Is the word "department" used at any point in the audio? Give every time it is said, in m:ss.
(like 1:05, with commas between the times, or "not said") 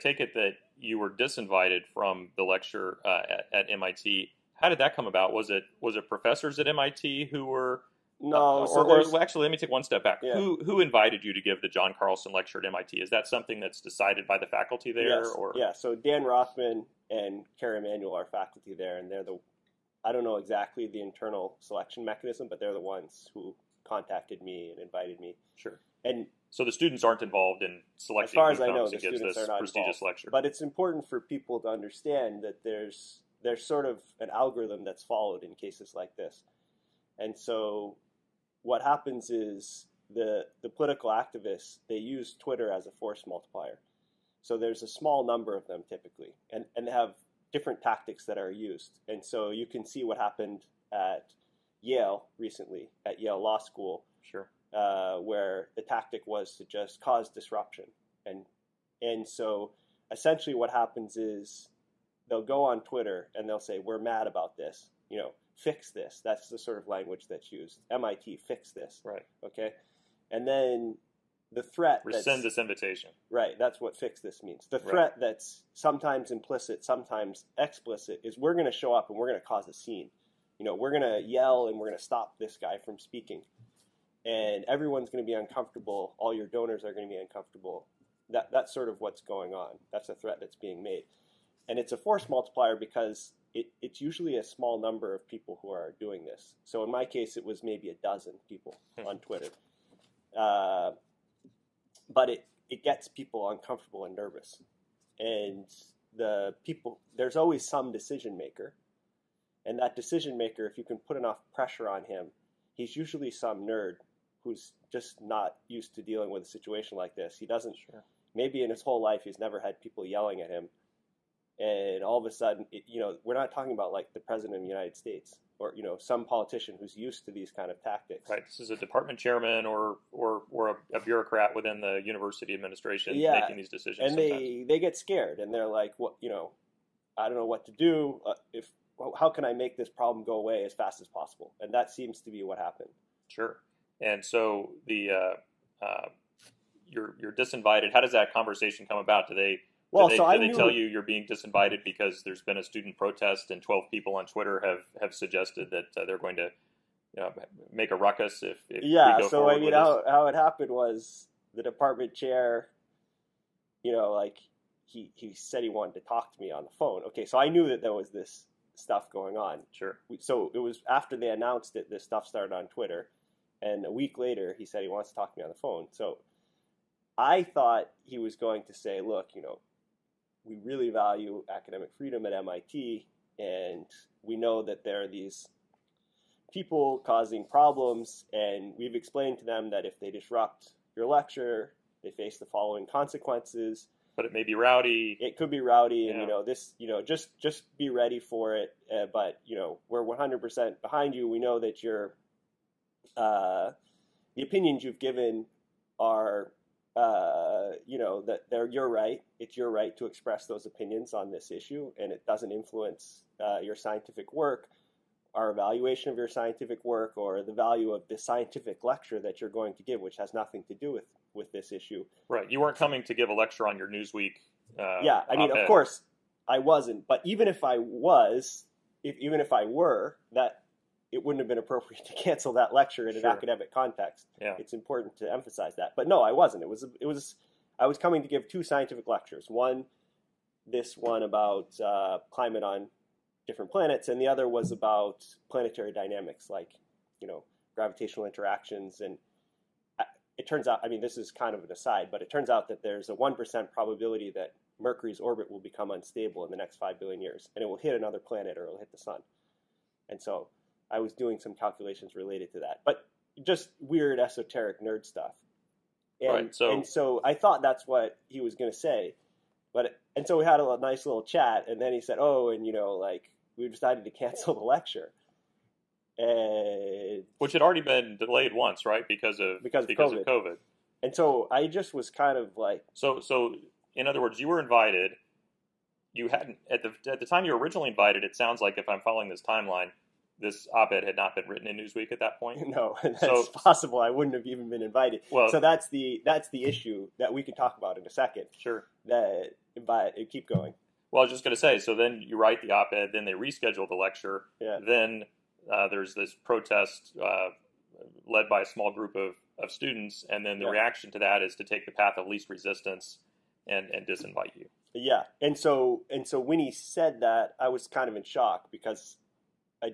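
2:08, 2:41.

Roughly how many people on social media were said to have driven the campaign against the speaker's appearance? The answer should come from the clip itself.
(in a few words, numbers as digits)
a dozen.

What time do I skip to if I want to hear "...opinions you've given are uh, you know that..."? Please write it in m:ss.
3:24.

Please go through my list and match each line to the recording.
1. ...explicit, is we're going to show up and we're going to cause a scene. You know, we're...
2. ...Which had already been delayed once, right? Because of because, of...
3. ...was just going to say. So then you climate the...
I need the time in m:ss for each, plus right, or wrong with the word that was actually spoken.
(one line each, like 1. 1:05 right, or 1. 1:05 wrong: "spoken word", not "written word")
1. 1:17 right
2. 4:37 right
3. 5:01 wrong: "write", not "climate".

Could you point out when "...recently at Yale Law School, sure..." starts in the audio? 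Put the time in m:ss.
0:52.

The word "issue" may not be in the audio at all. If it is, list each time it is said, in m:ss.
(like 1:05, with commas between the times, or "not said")
3:31, 3:41, 4:56.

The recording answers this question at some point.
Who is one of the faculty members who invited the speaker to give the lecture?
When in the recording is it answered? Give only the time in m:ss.
0:15.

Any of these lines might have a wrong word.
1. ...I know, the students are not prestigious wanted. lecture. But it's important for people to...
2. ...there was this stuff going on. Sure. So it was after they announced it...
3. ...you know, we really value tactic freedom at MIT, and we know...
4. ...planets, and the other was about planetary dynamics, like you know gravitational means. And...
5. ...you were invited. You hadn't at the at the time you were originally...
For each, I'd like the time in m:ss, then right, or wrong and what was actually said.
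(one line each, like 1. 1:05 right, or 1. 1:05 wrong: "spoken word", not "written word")
1. 0:28 wrong: "involved", not "wanted"
2. 2:47 right
3. 2:59 wrong: "academic", not "tactic"
4. 4:03 wrong: "interactions", not "means"
5. 4:44 right.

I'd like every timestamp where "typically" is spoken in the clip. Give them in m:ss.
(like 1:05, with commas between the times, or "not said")
0:45.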